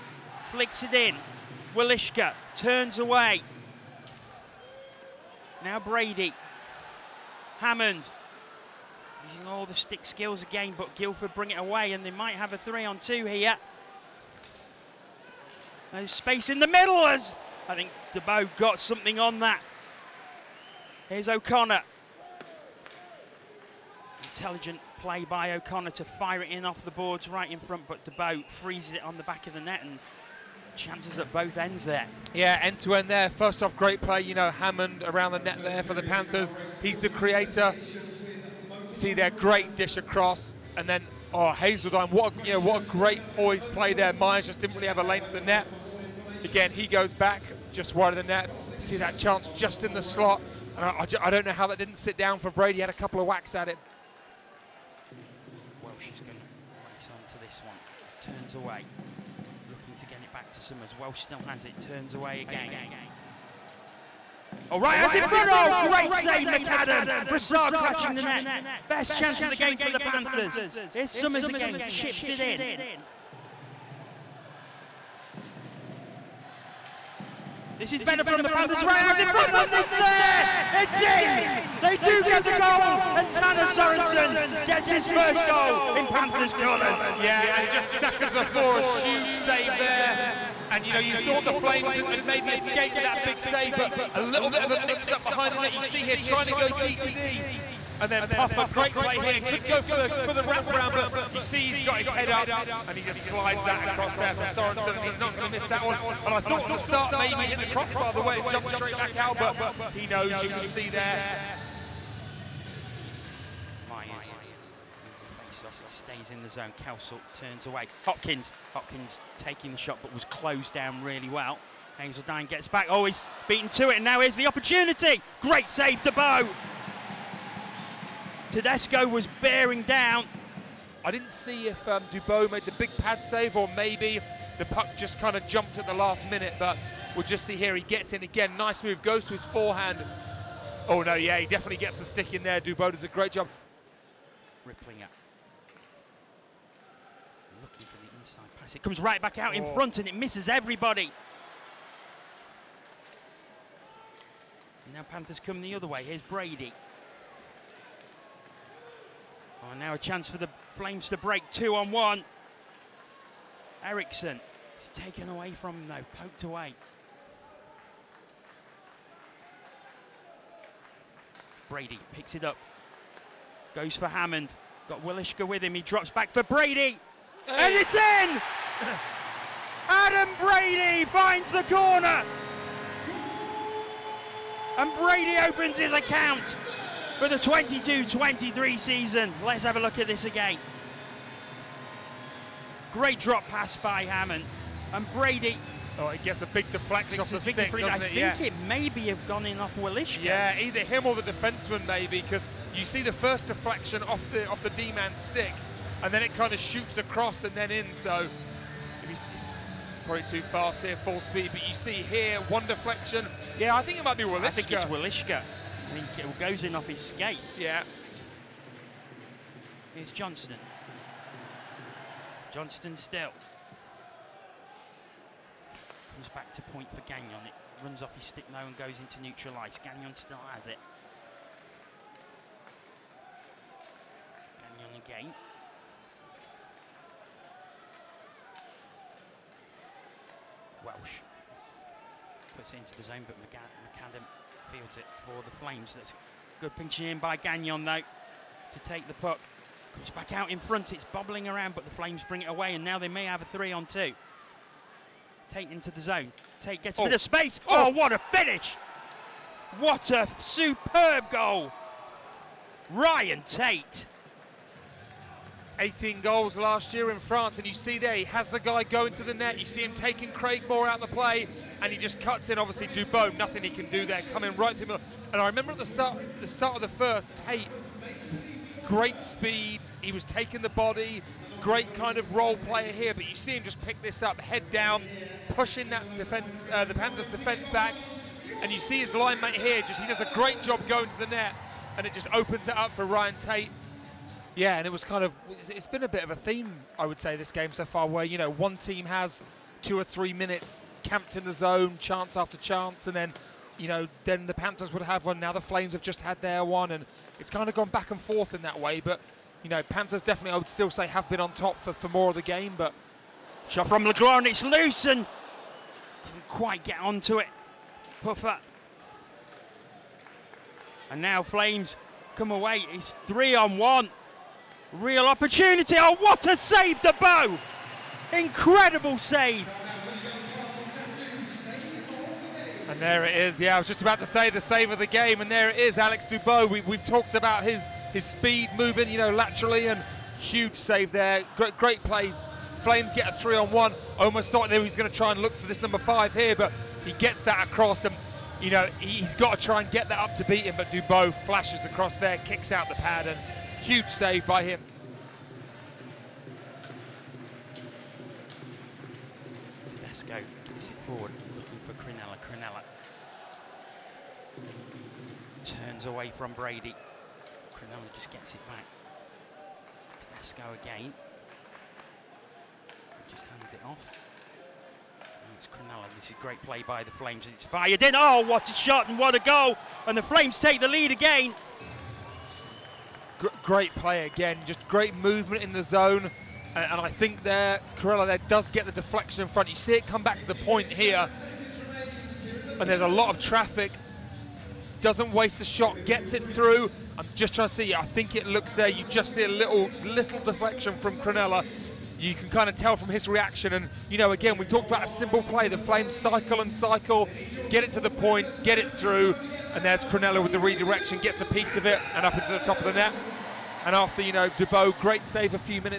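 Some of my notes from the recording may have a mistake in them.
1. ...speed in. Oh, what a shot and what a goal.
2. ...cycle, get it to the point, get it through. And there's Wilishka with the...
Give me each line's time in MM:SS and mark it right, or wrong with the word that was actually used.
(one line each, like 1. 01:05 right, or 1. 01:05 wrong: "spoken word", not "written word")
1. 06:17 wrong: "fired", not "speed"
2. 06:46 wrong: "Cronella", not "Wilishka".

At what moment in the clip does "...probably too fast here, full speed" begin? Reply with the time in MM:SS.
03:30.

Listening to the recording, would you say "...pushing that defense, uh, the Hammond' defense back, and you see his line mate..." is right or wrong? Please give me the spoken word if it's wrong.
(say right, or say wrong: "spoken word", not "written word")
wrong: "Panthers", not "Hammond".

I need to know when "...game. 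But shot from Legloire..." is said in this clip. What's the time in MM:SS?
05:12.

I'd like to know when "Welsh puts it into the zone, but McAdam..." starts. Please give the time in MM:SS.
04:00.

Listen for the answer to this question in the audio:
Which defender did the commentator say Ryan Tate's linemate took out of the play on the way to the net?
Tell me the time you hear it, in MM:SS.
04:30.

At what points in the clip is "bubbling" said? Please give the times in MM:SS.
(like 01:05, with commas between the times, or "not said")
04:11.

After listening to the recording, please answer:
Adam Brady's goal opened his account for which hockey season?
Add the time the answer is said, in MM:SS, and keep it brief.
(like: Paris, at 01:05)
2022-23, at 03:07.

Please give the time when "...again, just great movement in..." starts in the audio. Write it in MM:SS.
06:24.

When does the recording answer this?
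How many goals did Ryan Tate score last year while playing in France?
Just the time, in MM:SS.
04:25.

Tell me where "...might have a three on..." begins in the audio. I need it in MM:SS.
00:12.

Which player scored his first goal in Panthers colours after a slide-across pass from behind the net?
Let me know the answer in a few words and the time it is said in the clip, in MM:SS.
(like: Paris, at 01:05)
Tanner Sorensen, at 01:23.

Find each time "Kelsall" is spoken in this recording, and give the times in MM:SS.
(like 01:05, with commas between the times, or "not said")
01:56.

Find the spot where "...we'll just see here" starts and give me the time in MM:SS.
02:17.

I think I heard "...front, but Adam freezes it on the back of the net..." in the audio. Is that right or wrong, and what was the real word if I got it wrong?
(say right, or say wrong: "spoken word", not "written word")
wrong: "Dubeau", not "Adam".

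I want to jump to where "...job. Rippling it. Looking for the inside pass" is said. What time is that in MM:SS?
02:23.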